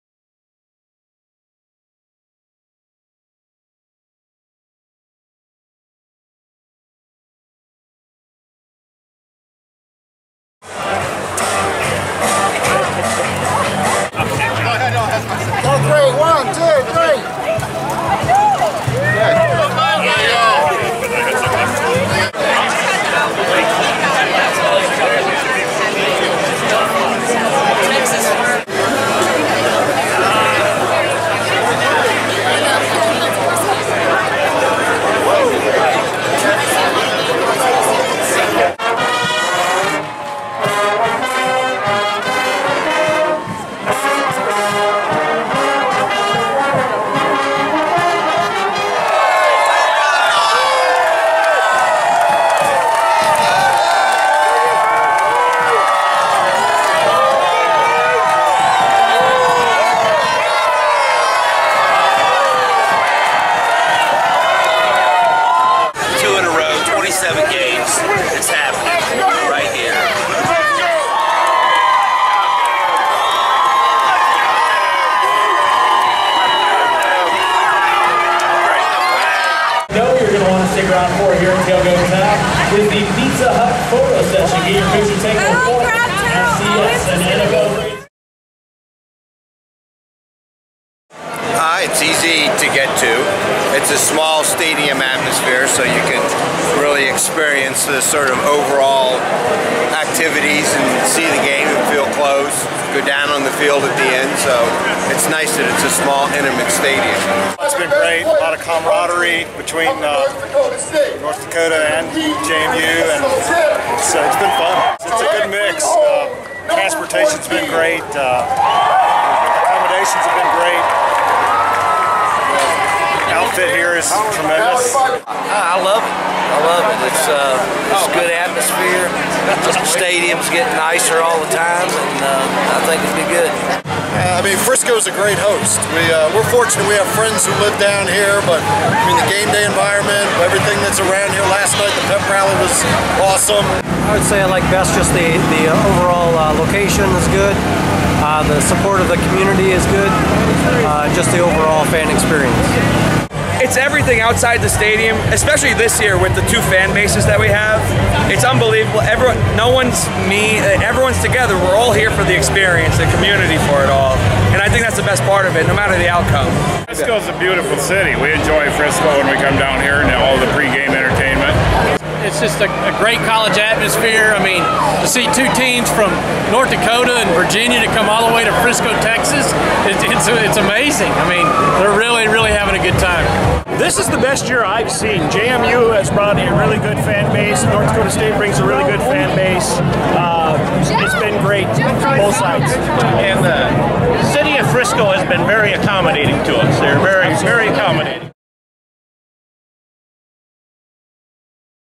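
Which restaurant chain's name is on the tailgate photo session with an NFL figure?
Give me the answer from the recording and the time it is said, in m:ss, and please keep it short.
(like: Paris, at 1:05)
Pizza Hut, at 1:23.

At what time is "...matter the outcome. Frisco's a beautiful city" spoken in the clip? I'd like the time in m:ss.
2:45.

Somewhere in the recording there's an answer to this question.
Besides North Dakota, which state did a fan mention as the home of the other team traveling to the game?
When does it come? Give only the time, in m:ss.
2:57.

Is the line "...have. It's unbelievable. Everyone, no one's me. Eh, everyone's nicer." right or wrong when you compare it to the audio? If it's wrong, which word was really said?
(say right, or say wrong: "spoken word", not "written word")
wrong: "together", not "nicer".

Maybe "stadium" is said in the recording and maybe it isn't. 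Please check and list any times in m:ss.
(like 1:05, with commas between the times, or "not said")
1:34, 1:46, 2:09, 2:34.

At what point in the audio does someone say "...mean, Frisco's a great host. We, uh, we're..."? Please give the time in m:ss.
2:14.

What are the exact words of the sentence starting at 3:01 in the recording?
I mean, they're really, really having a good time.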